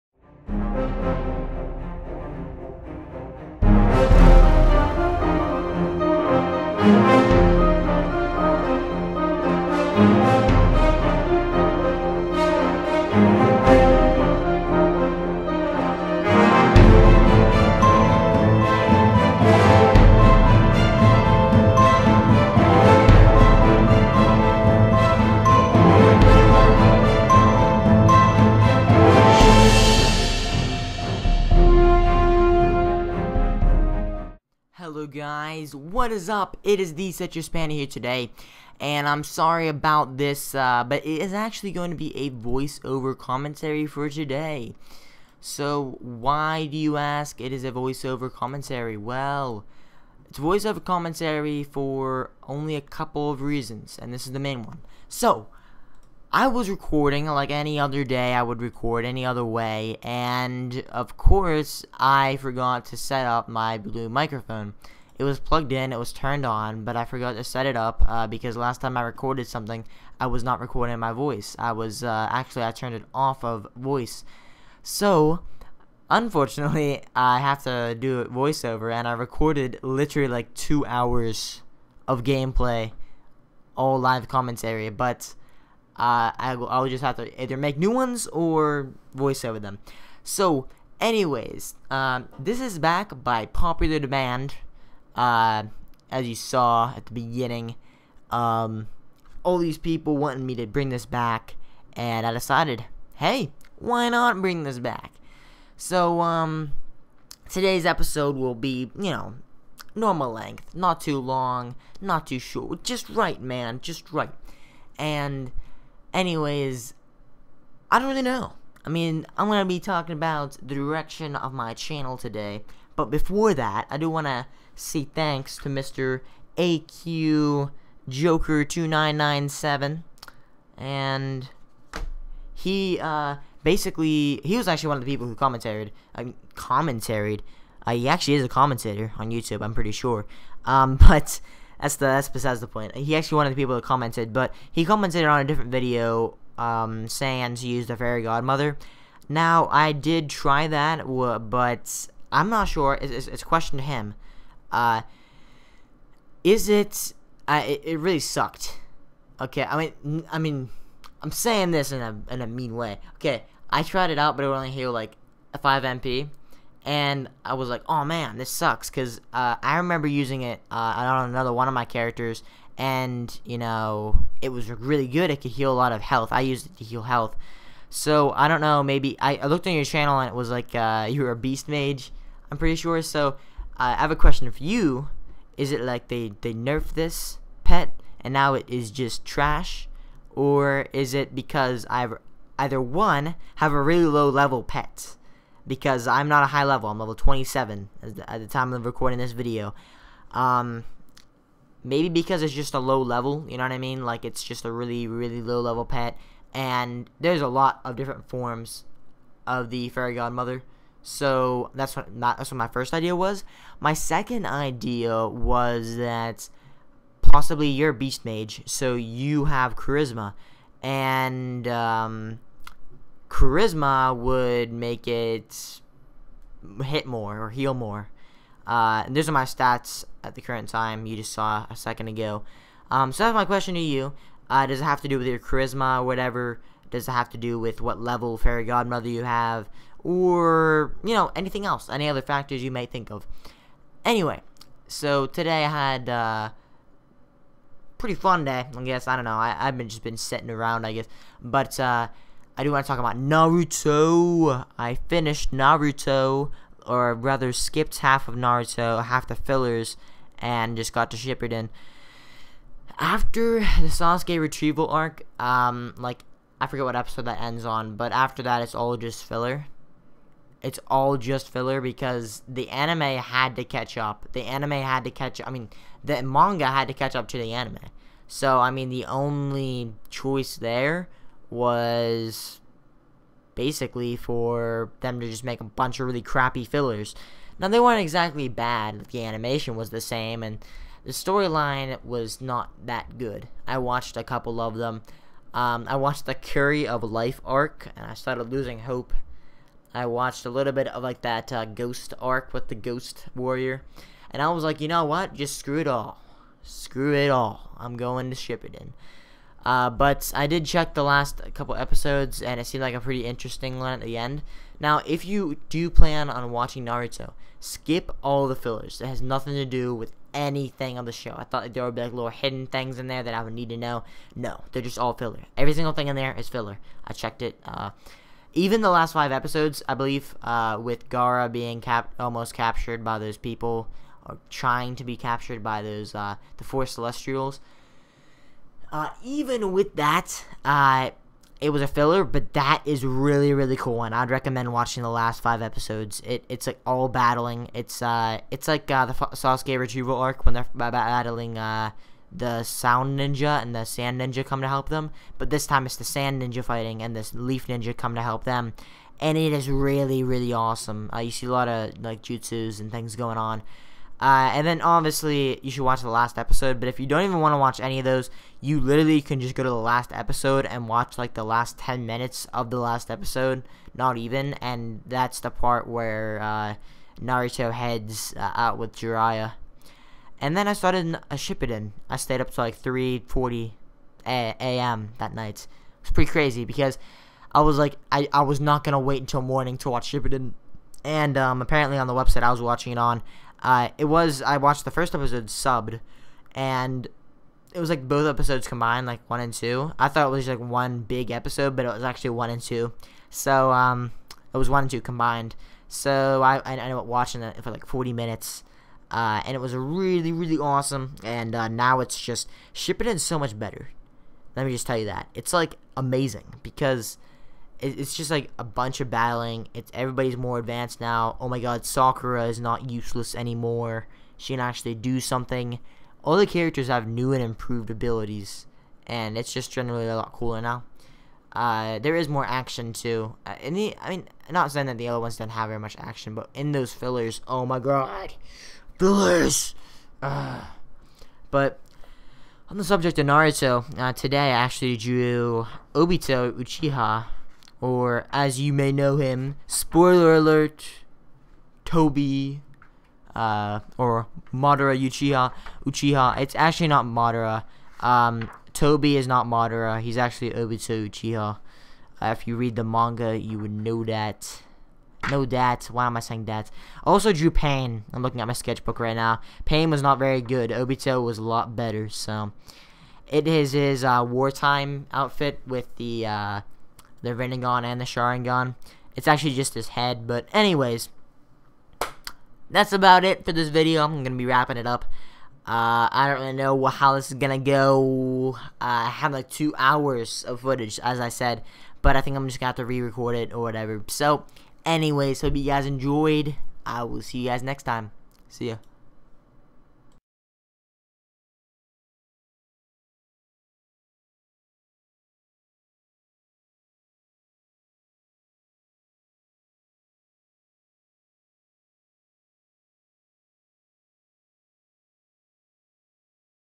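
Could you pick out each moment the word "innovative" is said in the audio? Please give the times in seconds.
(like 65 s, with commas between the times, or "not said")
not said.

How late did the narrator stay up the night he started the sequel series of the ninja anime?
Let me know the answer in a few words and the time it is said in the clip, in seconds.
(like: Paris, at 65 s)
3:40 a.m., at 382 s.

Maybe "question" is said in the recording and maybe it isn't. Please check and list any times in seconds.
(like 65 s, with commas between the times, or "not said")
153 s, 184 s, 233 s.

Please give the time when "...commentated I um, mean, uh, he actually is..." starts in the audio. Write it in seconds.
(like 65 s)
135 s.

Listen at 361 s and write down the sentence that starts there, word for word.
Uh, you see a lot of like jutsus and things going on.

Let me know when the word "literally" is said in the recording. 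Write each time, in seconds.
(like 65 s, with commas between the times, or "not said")
79 s, 368 s.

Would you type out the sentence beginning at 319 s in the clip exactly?
It has nothing to do with anything on the show.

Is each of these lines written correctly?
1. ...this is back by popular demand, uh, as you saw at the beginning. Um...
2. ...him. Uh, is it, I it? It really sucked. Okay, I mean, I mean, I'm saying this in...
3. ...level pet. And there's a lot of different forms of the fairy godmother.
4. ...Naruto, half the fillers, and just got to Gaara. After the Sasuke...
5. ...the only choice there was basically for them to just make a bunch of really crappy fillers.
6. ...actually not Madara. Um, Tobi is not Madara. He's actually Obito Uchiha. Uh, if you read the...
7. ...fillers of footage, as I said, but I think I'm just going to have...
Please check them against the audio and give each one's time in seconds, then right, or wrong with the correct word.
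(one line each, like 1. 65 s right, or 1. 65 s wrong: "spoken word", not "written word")
1. 92 s right
2. 153 s right
3. 205 s right
4. 258 s wrong: "Shippuden", not "Gaara"
5. 278 s right
6. 456 s right
7. 489 s wrong: "hours", not "fillers".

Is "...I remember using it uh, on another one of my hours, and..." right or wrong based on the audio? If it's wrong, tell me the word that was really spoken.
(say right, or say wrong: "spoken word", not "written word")
wrong: "characters", not "hours".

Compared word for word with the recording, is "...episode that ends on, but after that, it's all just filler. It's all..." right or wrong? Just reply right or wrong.
right.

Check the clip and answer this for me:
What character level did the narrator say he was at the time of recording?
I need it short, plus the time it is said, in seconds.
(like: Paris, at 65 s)
27, at 196 s.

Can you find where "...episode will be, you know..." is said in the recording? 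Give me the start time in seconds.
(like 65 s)
107 s.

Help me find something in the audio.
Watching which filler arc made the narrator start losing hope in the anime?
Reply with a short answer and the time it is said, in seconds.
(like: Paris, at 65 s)
Curry of Life arc, at 296 s.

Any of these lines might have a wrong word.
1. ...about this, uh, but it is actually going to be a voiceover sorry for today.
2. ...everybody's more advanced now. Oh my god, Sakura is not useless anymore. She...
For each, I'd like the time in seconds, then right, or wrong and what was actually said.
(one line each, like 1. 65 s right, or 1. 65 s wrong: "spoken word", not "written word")
1. 39 s wrong: "commentary", not "sorry"
2. 419 s right.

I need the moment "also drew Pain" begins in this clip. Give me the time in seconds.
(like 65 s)
467 s.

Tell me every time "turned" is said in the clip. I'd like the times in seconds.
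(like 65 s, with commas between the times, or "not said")
66 s, 72 s.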